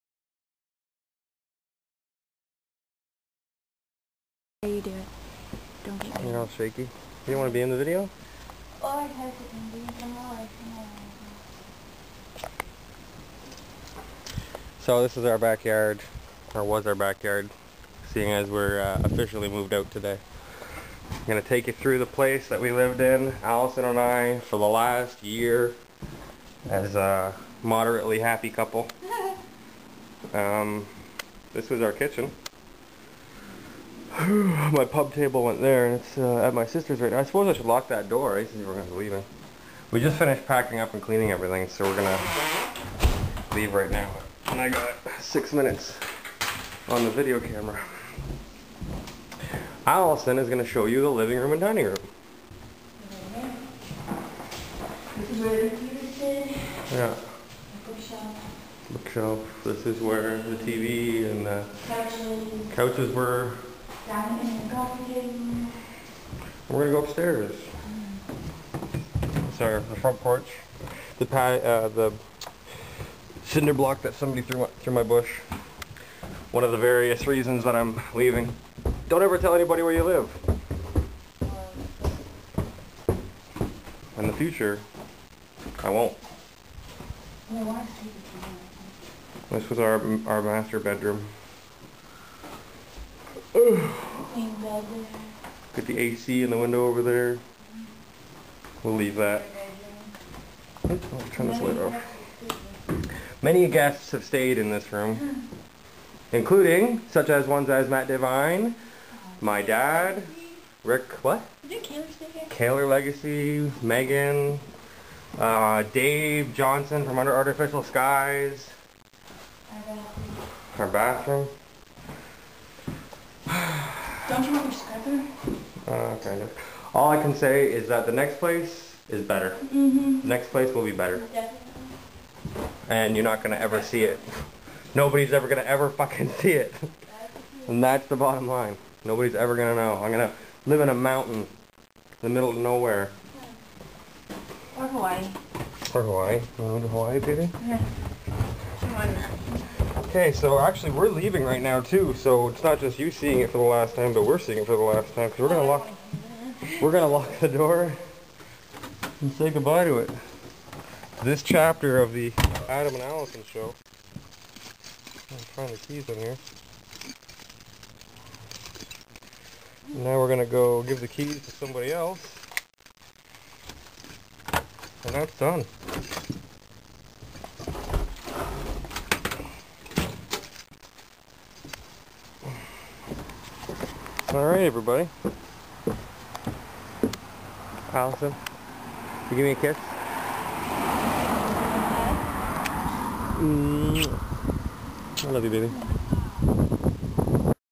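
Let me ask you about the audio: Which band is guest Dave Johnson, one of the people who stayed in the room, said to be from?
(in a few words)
Under Artificial Skies.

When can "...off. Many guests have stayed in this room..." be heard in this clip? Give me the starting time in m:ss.
1:41.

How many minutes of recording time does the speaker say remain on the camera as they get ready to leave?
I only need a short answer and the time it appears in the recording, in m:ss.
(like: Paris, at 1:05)
6, at 0:45.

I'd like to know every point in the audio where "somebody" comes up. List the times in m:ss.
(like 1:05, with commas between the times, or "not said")
1:14, 2:51.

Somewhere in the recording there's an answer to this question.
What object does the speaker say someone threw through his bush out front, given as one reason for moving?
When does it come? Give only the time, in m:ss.
1:13.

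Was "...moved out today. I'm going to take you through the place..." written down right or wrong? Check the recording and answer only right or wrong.
right.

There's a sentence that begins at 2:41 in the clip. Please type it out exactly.
This chapter of the Adam and Allison show.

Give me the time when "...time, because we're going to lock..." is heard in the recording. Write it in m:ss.
2:35.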